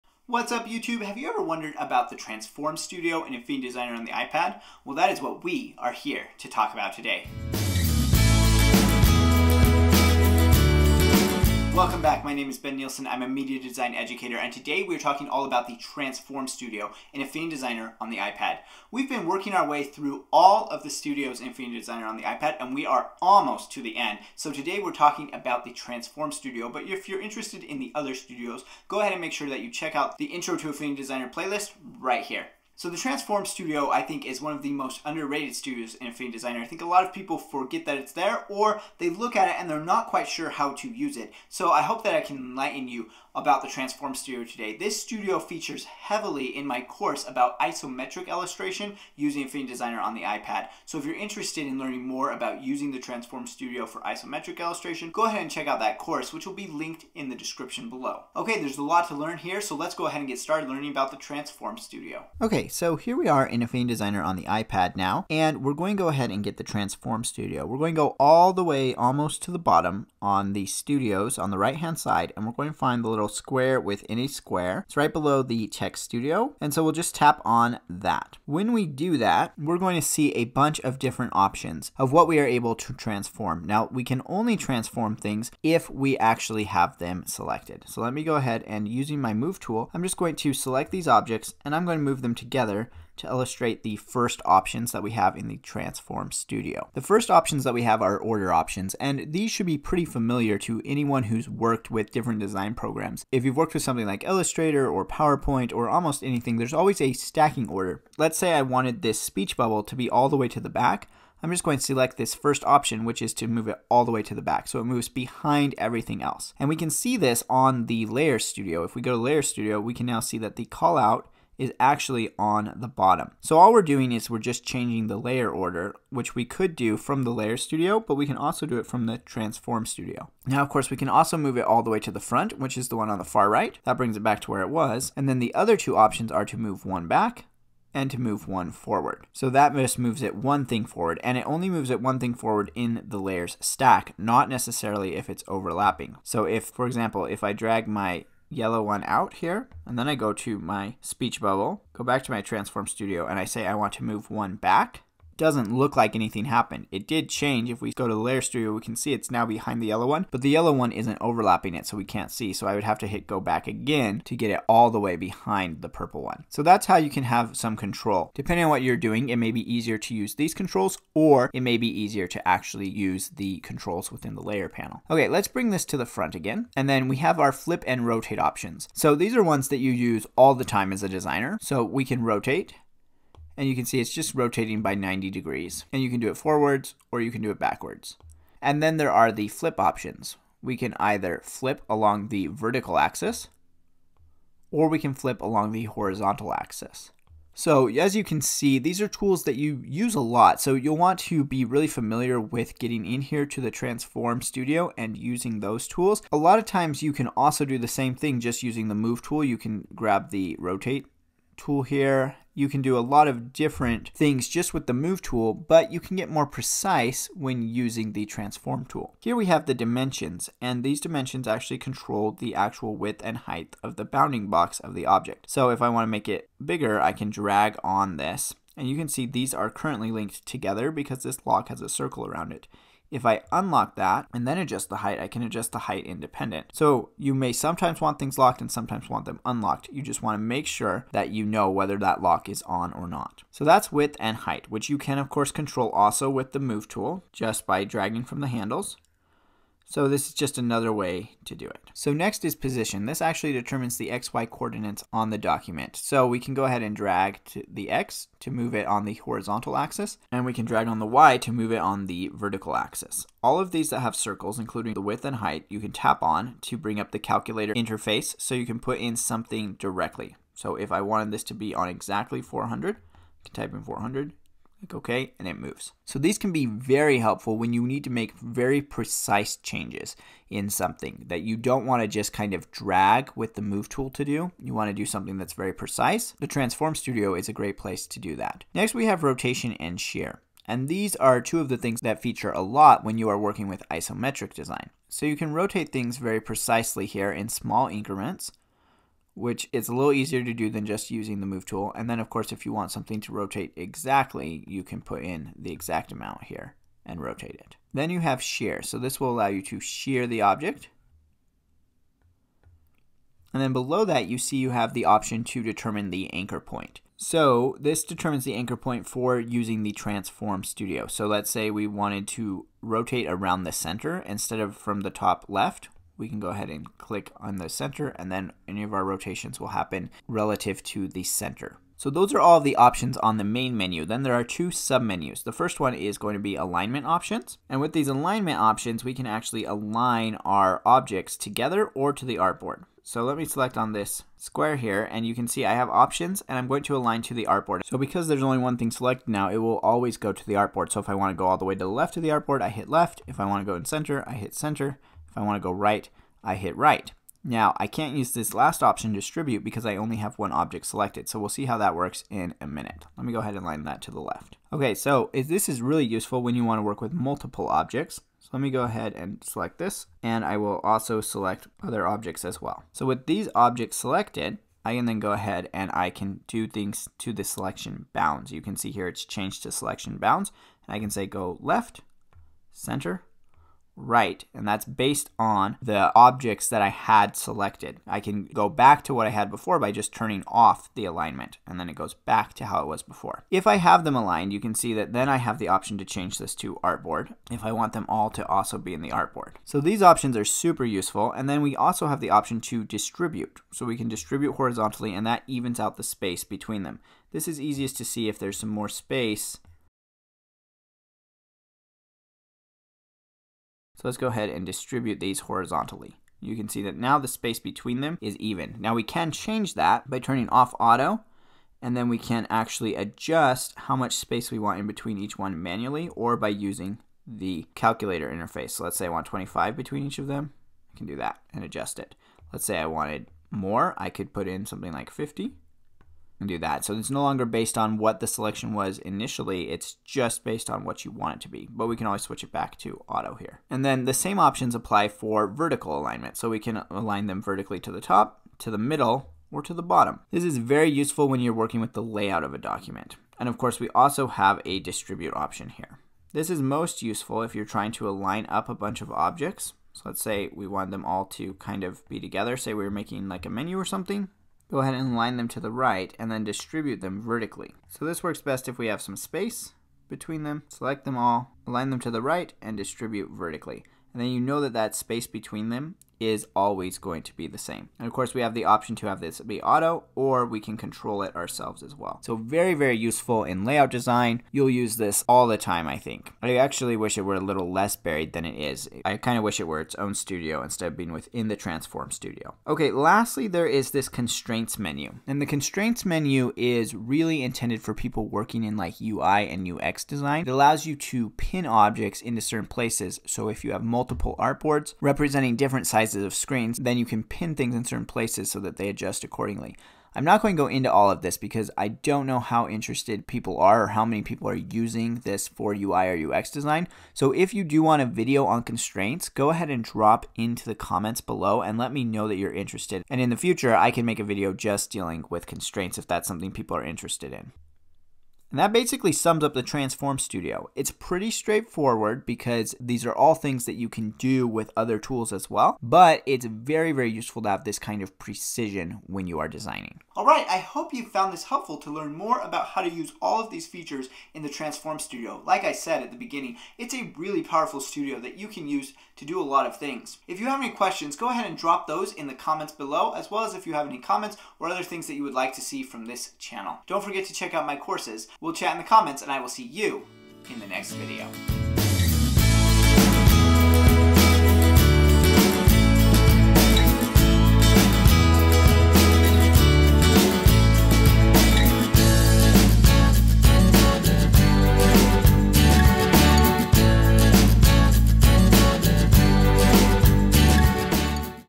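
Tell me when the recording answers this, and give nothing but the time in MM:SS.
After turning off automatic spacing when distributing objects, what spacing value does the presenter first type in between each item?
07:09.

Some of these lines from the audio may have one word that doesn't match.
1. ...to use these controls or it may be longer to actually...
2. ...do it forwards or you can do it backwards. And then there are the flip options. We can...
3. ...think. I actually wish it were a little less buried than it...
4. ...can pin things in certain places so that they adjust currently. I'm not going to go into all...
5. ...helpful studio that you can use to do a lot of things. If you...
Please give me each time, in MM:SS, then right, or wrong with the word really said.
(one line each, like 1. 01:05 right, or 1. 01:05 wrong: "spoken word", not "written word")
1. 02:49 wrong: "easier", not "longer"
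2. 03:06 right
3. 08:05 right
4. 08:27 wrong: "accordingly", not "currently"
5. 09:07 wrong: "powerful", not "helpful".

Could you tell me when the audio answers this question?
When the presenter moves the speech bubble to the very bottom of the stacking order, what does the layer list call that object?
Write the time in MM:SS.
02:00.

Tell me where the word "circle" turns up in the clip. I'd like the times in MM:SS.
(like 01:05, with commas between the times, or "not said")
03:51, 04:24.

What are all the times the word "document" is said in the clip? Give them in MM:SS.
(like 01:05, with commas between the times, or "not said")
04:15, 07:32.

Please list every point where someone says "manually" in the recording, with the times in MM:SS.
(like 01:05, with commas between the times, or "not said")
07:05.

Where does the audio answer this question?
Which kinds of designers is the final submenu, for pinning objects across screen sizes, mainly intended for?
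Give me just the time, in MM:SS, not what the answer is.
08:19.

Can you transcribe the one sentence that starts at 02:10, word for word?
Now, of course, we can also move it all the way to the front, which is the one on the far right.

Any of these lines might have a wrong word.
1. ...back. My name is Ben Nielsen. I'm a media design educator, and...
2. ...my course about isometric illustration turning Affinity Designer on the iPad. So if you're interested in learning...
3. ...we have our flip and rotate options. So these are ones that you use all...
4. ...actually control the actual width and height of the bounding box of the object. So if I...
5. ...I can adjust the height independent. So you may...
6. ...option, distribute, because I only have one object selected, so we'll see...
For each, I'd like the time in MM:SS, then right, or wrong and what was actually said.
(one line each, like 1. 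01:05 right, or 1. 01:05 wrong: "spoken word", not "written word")
1. 00:12 right
2. 00:46 wrong: "using", not "turning"
3. 02:57 right
4. 03:41 right
5. 03:55 right
6. 05:58 right.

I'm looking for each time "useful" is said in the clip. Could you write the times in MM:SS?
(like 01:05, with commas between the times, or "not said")
06:06, 06:40, 07:30, 07:37, 08:02, 08:57.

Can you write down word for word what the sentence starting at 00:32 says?
So the Transform Studio, I think, is one of the most underrated studios in Affinity Designer.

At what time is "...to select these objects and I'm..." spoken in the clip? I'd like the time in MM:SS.
01:30.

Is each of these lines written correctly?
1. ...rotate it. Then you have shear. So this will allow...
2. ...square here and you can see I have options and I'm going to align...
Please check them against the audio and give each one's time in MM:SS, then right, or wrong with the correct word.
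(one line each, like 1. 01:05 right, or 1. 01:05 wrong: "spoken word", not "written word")
1. 05:07 right
2. 05:44 right.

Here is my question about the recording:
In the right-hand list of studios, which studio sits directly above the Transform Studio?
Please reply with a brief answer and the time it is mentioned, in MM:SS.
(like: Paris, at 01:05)
text studio, at 01:15.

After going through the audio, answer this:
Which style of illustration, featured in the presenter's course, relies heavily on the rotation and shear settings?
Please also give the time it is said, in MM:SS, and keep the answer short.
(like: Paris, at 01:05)
isometric design, at 04:53.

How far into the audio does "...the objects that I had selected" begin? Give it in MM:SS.
06:25.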